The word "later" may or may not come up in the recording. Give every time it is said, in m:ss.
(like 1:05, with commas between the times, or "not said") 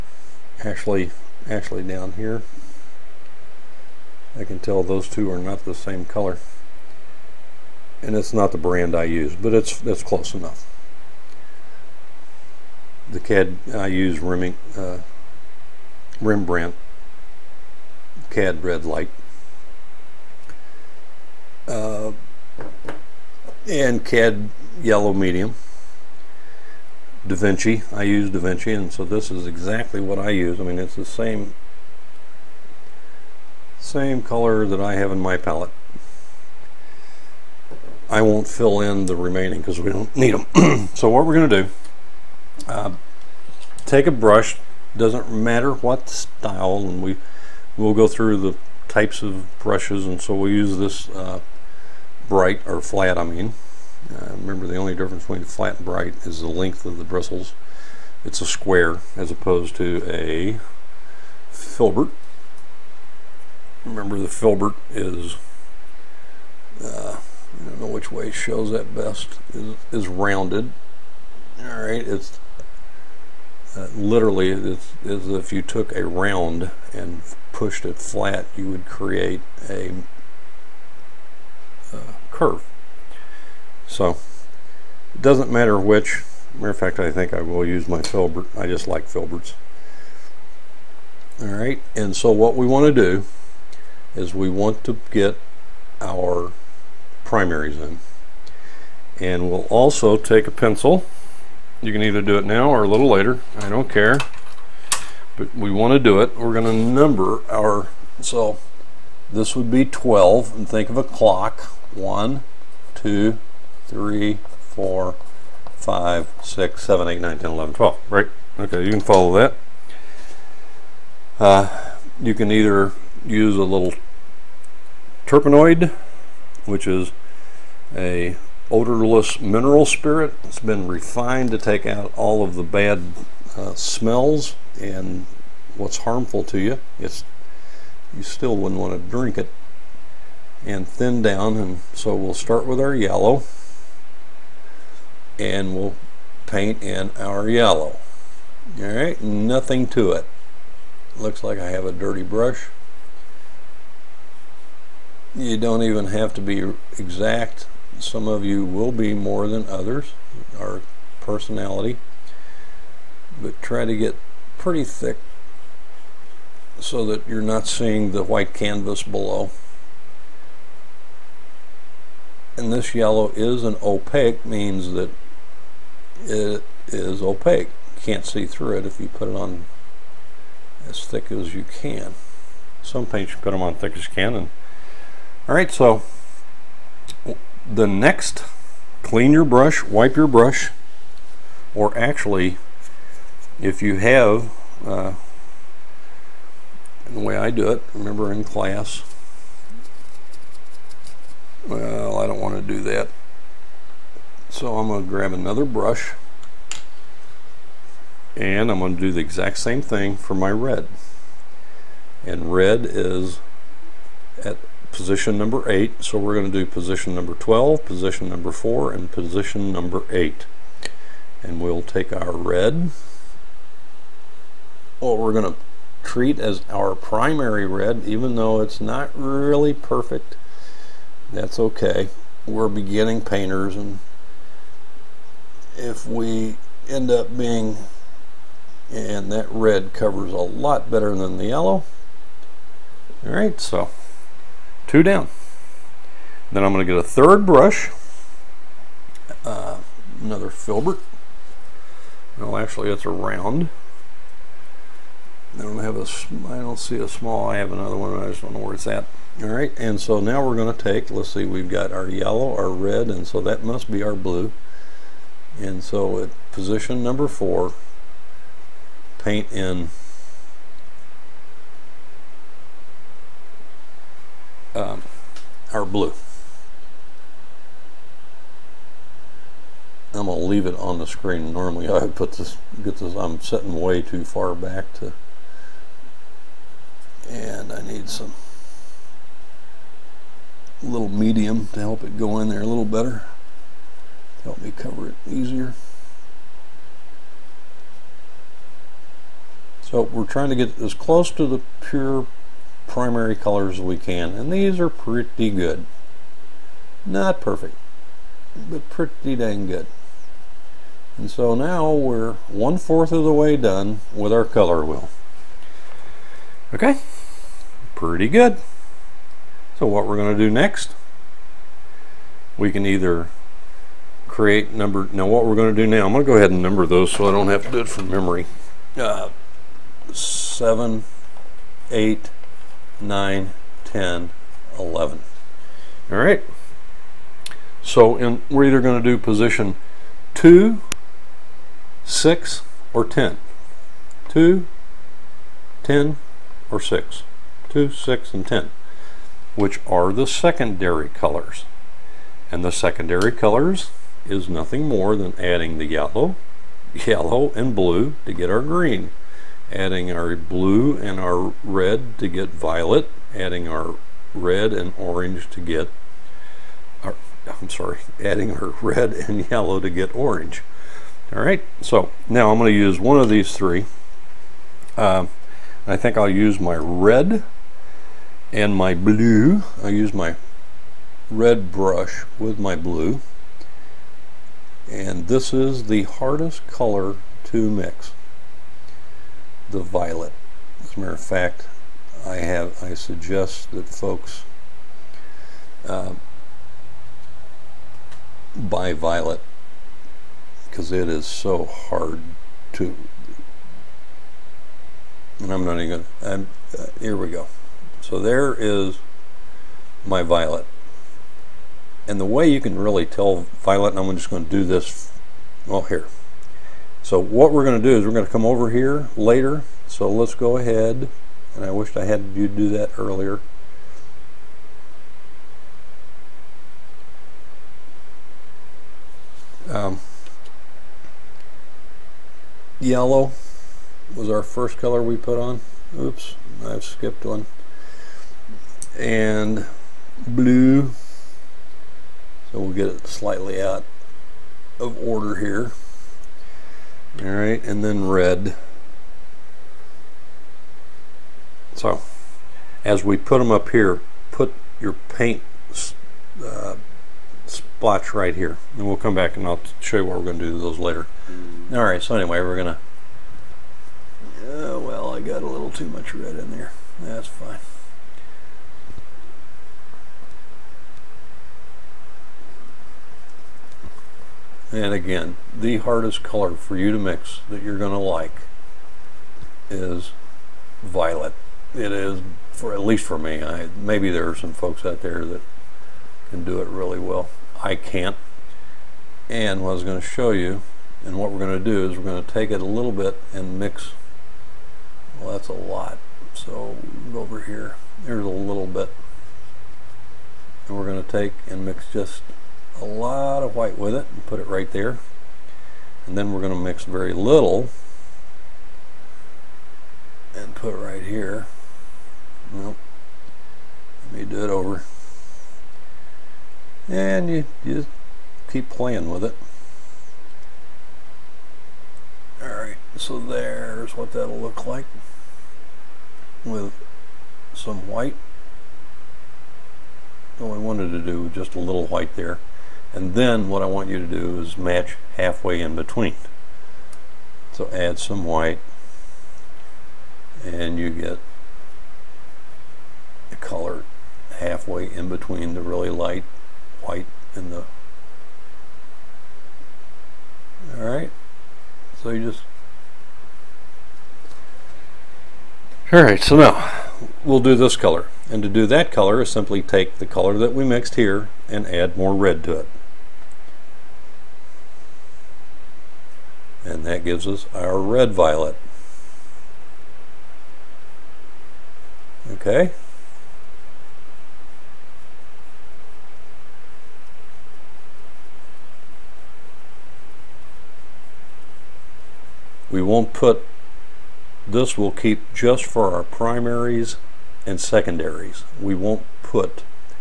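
1:43, 6:59, 7:40.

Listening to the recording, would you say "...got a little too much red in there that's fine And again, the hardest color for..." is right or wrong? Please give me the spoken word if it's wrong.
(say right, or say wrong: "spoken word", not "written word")
right.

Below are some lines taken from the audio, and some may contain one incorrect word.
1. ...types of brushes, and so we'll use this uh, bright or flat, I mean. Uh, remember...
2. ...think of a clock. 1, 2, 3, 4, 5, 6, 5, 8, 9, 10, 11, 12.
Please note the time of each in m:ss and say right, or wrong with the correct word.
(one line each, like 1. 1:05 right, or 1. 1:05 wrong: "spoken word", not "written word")
1. 0:48 right
2. 1:50 wrong: "7", not "5".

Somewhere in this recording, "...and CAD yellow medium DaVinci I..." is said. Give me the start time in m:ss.
0:23.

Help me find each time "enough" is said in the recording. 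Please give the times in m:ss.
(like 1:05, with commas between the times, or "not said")
0:10.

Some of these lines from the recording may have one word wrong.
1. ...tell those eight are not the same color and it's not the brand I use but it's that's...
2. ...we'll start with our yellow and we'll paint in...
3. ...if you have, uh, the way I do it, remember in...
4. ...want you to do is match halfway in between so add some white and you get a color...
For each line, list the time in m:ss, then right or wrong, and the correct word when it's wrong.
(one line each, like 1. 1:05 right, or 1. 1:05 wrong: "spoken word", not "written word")
1. 0:04 wrong: "two", not "eight"
2. 2:22 right
3. 3:13 right
4. 8:53 right.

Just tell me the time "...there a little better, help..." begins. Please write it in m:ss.
4:52.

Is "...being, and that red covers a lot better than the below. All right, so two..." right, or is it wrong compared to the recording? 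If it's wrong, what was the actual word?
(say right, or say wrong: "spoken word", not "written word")
wrong: "yellow", not "below".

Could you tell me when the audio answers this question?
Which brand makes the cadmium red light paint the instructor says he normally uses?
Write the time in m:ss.
0:16.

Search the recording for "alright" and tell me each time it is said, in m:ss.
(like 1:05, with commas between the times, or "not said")
2:28, 8:42, 9:10, 9:15.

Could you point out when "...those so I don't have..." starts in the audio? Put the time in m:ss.
5:26.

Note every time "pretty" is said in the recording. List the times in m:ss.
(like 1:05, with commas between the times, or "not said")
2:44, 5:04, 5:08, 5:17.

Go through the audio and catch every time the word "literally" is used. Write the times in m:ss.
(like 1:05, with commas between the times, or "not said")
1:13.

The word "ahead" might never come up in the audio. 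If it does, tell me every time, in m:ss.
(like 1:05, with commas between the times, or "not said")
5:26, 7:00.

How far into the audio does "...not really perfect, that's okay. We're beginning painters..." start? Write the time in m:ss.
3:48.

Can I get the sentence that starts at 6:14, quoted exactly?
Uh, I think I'll use my red and my blue.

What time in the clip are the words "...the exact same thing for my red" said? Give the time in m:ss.
3:29.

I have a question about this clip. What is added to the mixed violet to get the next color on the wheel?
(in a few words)
More red.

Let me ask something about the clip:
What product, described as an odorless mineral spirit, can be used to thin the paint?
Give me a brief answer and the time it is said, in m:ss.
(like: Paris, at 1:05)
Turpenoid, at 2:05.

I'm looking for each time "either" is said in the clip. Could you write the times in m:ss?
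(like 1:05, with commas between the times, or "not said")
1:42, 2:02, 5:22, 5:38.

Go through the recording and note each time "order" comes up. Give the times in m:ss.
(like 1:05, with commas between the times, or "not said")
7:25.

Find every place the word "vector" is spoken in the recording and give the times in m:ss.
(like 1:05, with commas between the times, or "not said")
not said.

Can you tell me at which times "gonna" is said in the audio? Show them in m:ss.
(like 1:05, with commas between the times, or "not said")
4:40, 7:42.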